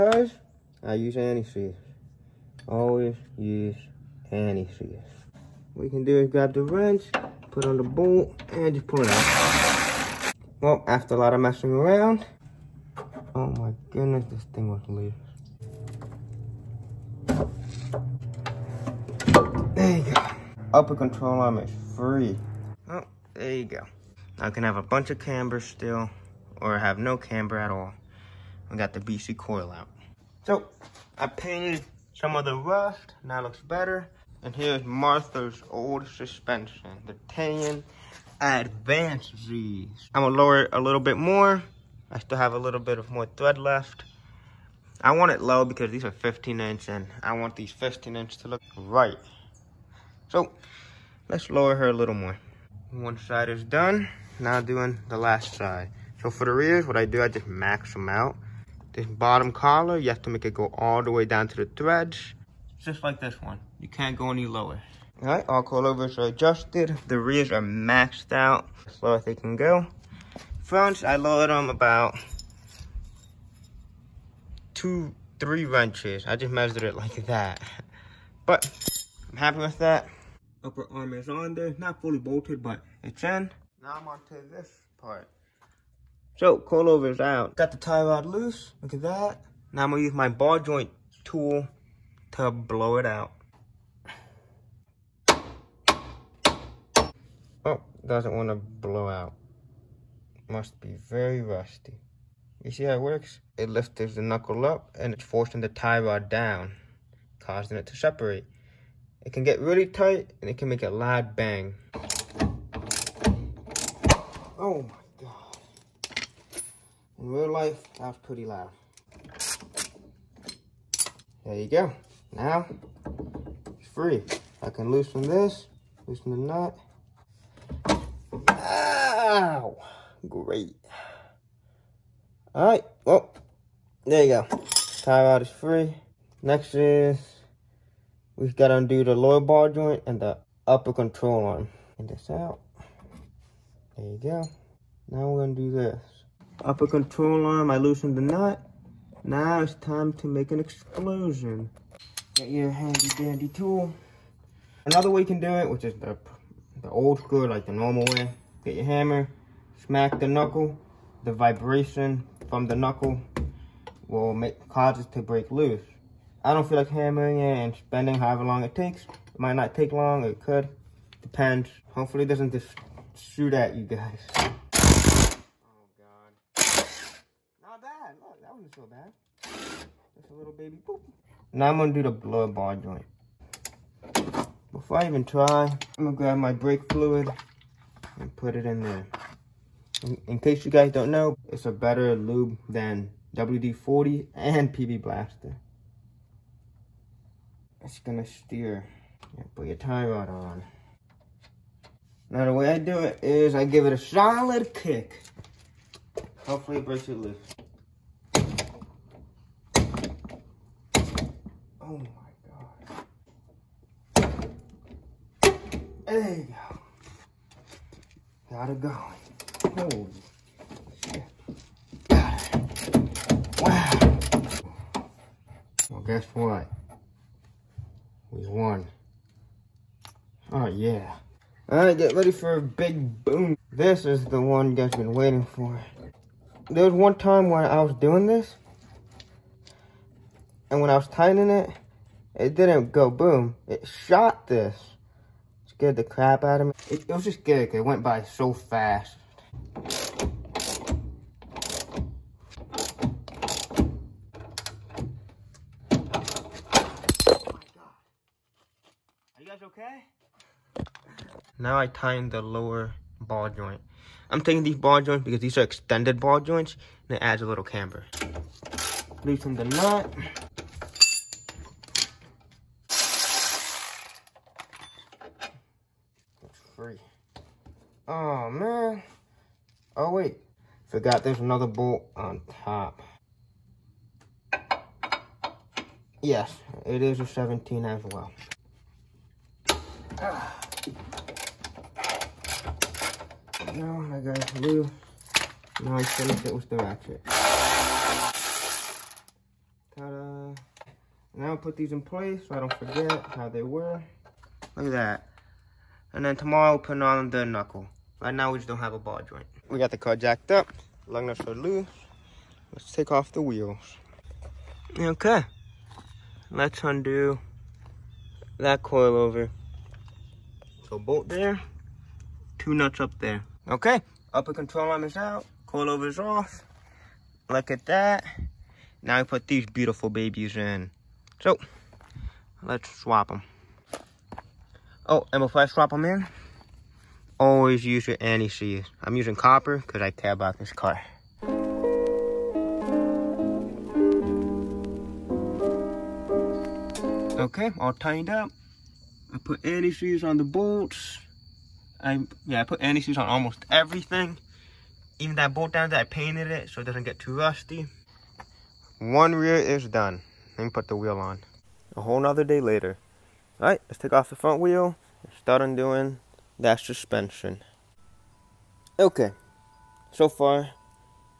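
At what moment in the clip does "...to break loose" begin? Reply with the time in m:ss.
2:45.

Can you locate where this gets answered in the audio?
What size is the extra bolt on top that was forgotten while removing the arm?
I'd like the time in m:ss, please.
4:47.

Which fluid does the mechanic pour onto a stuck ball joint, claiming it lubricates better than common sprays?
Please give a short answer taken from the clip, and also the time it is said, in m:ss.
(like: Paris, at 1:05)
brake fluid, at 3:06.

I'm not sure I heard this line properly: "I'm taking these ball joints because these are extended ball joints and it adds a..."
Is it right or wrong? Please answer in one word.
right.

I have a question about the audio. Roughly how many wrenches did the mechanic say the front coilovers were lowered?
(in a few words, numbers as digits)
two, three.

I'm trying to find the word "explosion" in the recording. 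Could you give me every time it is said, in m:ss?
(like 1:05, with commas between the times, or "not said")
2:30.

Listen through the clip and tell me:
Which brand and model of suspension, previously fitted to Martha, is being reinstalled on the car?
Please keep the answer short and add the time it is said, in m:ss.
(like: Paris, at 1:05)
Tein Advanced Z, at 0:37.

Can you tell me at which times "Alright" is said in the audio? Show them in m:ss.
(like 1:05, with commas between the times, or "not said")
3:51, 6:03.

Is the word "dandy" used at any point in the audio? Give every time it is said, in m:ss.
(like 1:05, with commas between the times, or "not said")
2:33.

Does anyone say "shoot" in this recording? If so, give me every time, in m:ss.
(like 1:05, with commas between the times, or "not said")
2:53.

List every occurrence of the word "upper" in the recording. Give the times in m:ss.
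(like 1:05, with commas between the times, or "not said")
0:20, 1:20, 2:20, 2:26, 5:24.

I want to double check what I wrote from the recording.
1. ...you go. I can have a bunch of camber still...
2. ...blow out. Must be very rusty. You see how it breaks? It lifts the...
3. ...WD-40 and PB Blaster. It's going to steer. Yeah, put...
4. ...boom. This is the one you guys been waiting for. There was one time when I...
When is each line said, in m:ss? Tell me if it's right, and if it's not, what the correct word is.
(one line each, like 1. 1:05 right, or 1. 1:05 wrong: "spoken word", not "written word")
1. 0:23 right
2. 1:38 wrong: "works", not "breaks"
3. 3:13 right
4. 3:53 right.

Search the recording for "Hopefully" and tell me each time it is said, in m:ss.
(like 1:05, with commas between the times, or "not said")
2:51, 3:26.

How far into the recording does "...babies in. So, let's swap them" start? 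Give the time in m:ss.
5:30.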